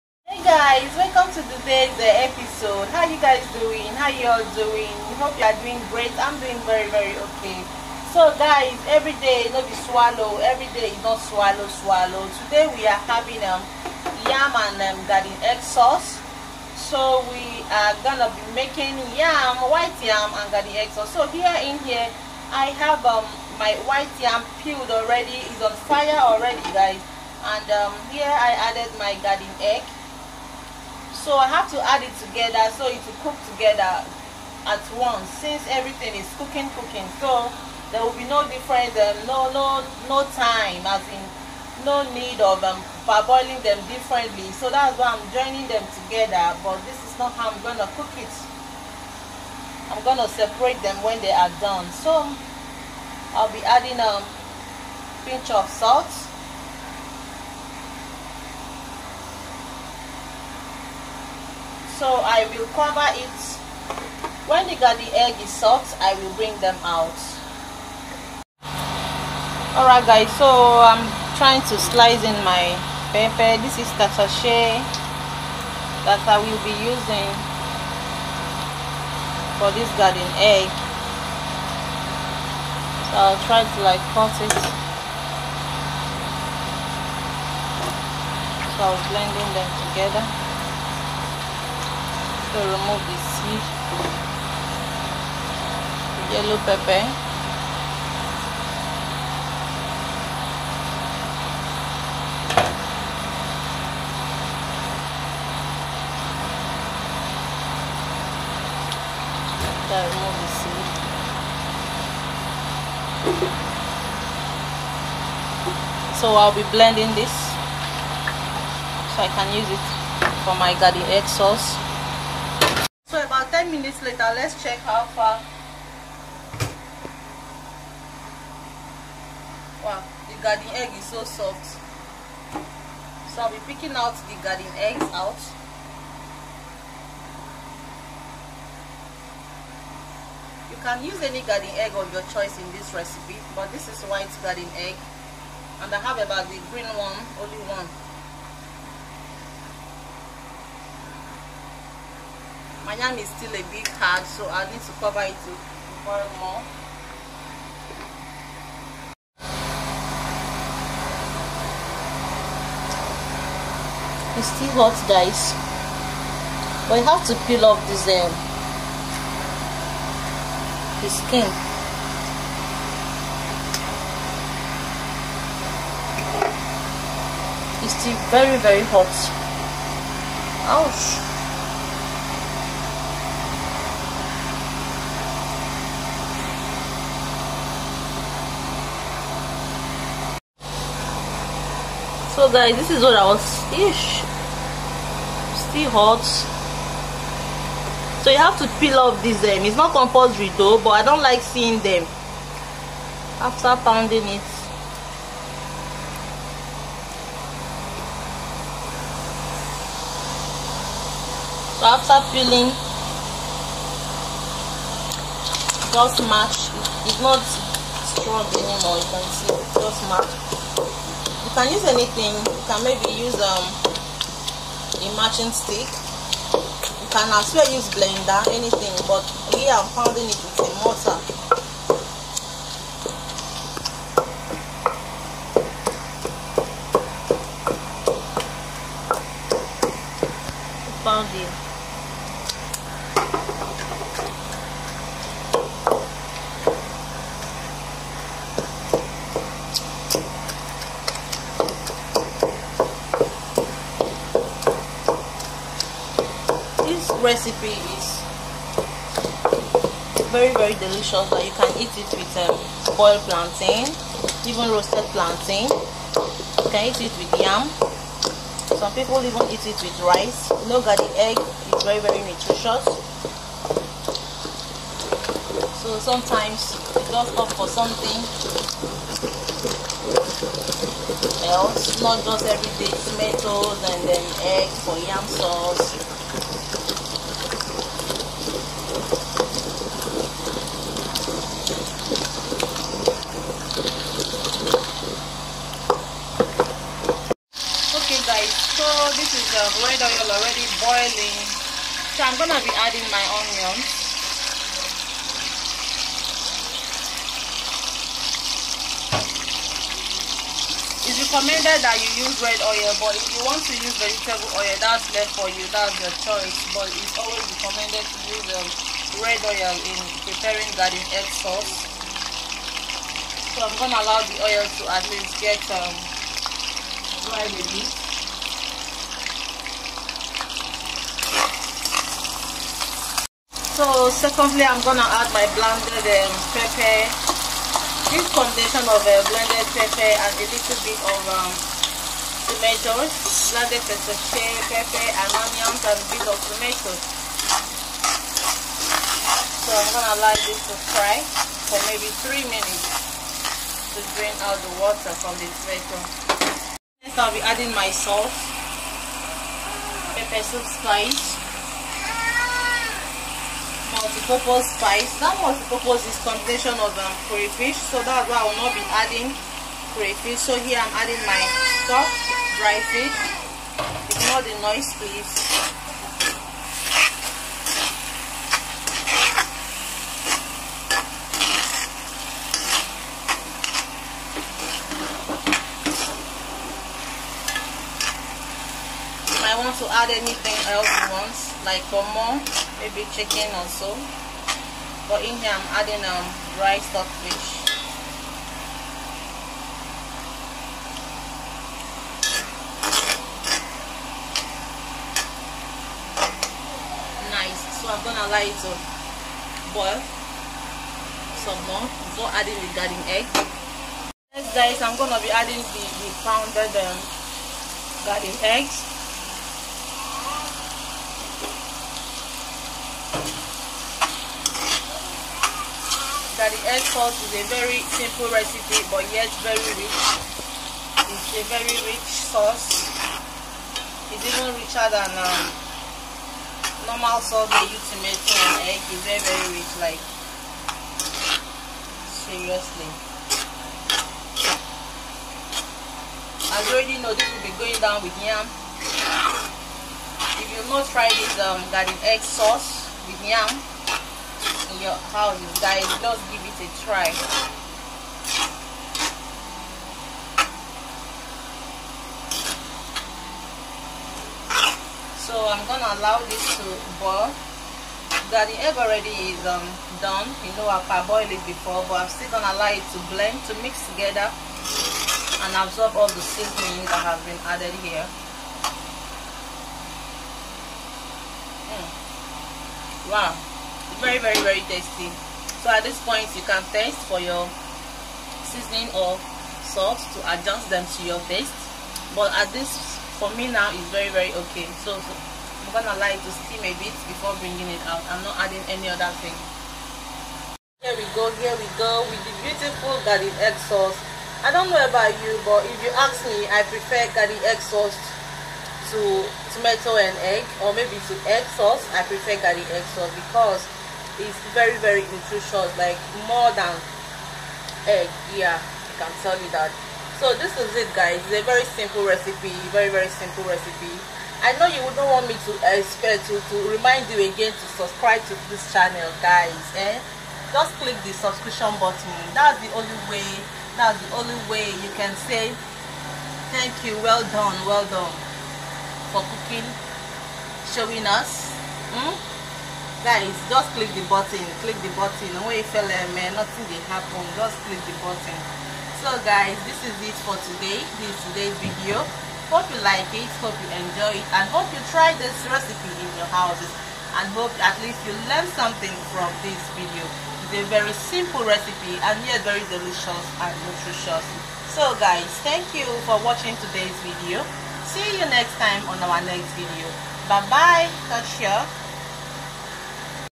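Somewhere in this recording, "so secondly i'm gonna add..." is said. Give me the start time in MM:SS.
05:33.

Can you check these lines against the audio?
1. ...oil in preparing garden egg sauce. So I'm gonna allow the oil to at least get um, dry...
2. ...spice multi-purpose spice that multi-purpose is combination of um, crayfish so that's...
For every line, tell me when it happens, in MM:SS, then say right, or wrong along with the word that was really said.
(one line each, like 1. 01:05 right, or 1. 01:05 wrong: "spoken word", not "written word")
1. 05:19 right
2. 06:00 right.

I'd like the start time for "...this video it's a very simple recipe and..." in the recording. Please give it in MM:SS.
09:19.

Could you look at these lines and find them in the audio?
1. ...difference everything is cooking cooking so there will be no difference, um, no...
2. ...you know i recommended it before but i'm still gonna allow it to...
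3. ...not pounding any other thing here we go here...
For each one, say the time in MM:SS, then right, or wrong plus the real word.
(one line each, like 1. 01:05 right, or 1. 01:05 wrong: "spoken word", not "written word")
1. 00:35 wrong: "since", not "difference"
2. 07:50 wrong: "parboiled", not "recommended"
3. 08:18 wrong: "adding", not "pounding".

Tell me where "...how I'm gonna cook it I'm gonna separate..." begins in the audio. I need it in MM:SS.
00:47.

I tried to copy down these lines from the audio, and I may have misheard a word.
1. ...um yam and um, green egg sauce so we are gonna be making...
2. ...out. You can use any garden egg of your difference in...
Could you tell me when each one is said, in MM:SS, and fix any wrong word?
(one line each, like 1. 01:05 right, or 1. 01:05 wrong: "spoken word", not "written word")
1. 00:13 wrong: "garden", not "green"
2. 02:15 wrong: "choice", not "difference".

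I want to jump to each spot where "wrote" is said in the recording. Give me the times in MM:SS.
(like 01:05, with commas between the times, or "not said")
not said.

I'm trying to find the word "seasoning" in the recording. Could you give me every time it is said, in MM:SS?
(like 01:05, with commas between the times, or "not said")
07:56, 08:08.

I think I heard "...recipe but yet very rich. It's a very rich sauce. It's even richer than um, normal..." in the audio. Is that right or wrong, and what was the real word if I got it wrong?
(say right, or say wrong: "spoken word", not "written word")
right.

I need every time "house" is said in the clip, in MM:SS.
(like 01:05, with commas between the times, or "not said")
07:35, 09:16.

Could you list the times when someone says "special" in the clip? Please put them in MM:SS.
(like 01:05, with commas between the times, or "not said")
not said.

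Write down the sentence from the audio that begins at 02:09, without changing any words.
Wow, the garden egg is so soft.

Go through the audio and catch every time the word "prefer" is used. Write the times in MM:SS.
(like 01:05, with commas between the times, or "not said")
08:26, 08:32.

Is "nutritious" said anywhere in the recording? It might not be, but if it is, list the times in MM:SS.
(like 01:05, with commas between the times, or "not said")
04:32, 08:35, 09:23.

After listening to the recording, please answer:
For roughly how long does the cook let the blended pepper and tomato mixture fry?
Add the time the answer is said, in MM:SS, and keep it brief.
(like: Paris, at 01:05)
3 minutes, at 05:52.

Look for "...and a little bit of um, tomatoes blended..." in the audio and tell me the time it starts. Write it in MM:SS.
05:40.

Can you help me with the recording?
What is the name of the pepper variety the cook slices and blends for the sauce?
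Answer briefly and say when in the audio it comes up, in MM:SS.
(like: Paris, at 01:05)
Tatashe, at 01:14.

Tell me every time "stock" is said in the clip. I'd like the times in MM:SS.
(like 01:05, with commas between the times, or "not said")
06:11.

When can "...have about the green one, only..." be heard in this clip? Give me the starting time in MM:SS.
02:25.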